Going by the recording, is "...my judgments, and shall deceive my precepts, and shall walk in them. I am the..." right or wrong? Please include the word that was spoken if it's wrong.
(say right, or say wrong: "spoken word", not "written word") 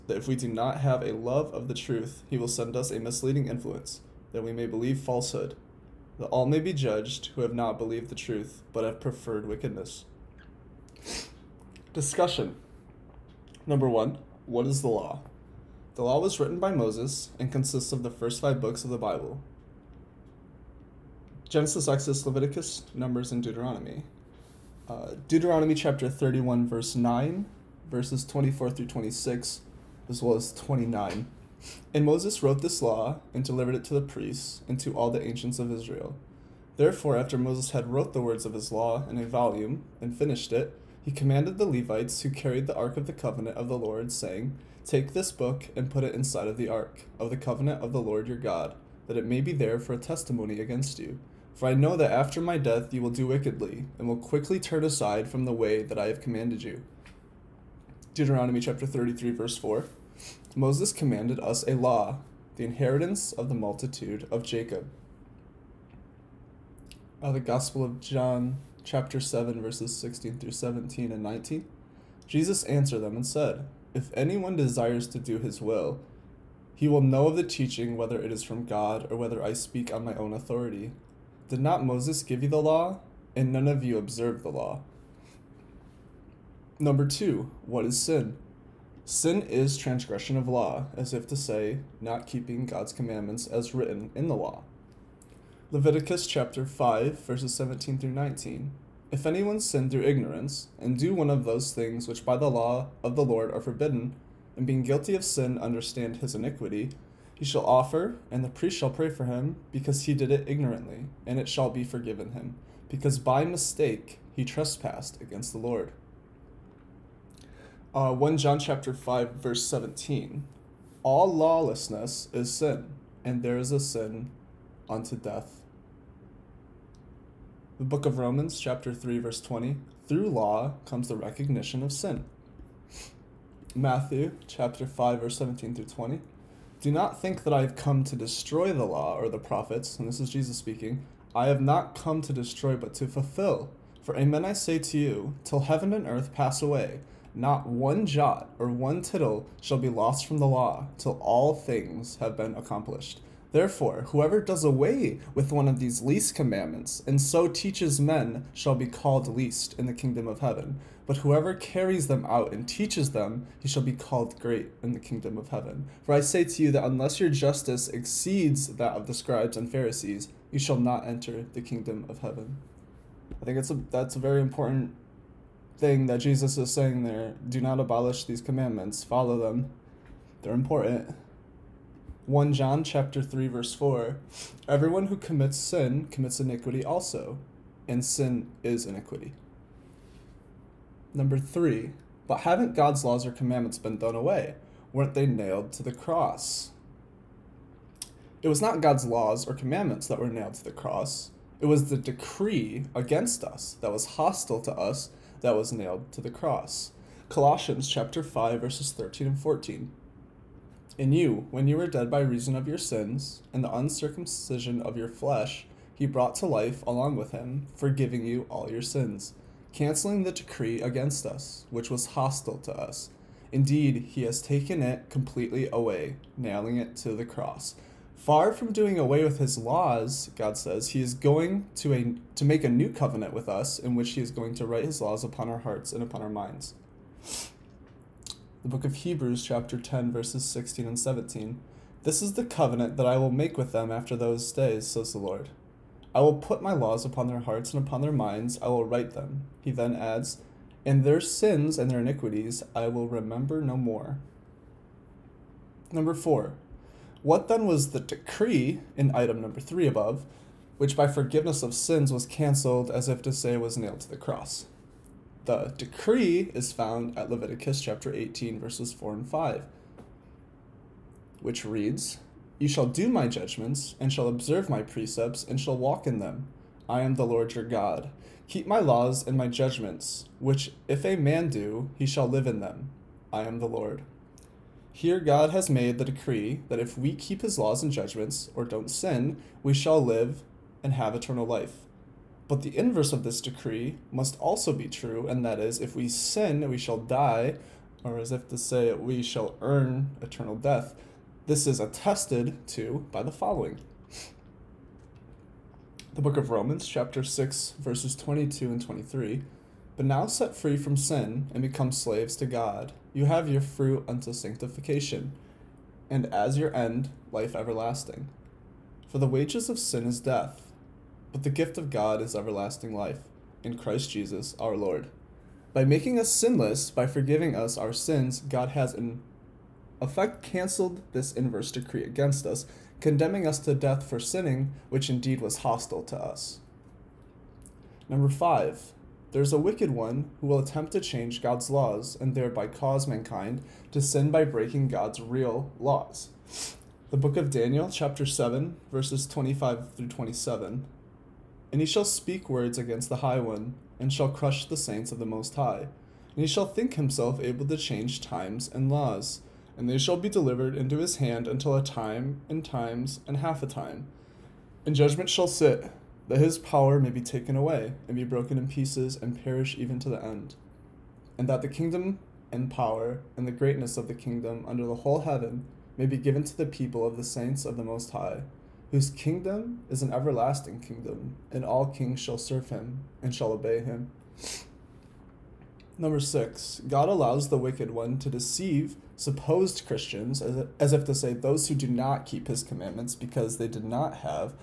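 wrong: "observe", not "deceive".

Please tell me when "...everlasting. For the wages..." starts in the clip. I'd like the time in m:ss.
5:17.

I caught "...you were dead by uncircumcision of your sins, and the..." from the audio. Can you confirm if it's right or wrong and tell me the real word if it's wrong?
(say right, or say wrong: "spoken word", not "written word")
wrong: "reason", not "uncircumcision".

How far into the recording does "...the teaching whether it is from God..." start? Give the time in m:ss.
1:17.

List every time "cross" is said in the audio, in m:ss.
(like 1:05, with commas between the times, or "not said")
3:15, 3:20, 3:26, 3:47, 4:24.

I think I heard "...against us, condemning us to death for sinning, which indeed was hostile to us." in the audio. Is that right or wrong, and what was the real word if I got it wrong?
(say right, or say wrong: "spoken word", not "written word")
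right.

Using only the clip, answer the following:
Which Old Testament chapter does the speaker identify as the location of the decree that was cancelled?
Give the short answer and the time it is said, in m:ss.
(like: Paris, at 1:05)
Leviticus 18, at 4:27.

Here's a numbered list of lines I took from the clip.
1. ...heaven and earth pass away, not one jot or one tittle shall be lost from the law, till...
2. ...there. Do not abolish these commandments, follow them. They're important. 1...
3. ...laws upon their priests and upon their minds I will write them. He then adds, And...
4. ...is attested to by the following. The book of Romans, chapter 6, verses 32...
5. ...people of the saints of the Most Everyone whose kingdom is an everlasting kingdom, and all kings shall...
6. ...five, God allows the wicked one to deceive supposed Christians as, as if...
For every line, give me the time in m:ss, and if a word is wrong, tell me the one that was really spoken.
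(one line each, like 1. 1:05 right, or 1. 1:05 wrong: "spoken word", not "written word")
1. 2:25 right
2. 2:57 right
3. 4:06 wrong: "hearts", not "priests"
4. 5:01 wrong: "22", not "32"
5. 6:16 wrong: "High", not "Everyone"
6. 6:26 wrong: "six", not "five".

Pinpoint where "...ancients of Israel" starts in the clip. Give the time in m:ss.
0:35.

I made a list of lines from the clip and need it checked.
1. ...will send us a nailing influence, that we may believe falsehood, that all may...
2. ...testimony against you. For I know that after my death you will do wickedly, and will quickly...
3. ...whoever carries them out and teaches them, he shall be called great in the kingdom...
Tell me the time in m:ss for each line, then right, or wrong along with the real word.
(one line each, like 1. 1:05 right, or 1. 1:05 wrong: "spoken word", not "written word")
1. 0:02 wrong: "misleading", not "nailing"
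2. 0:49 right
3. 2:41 right.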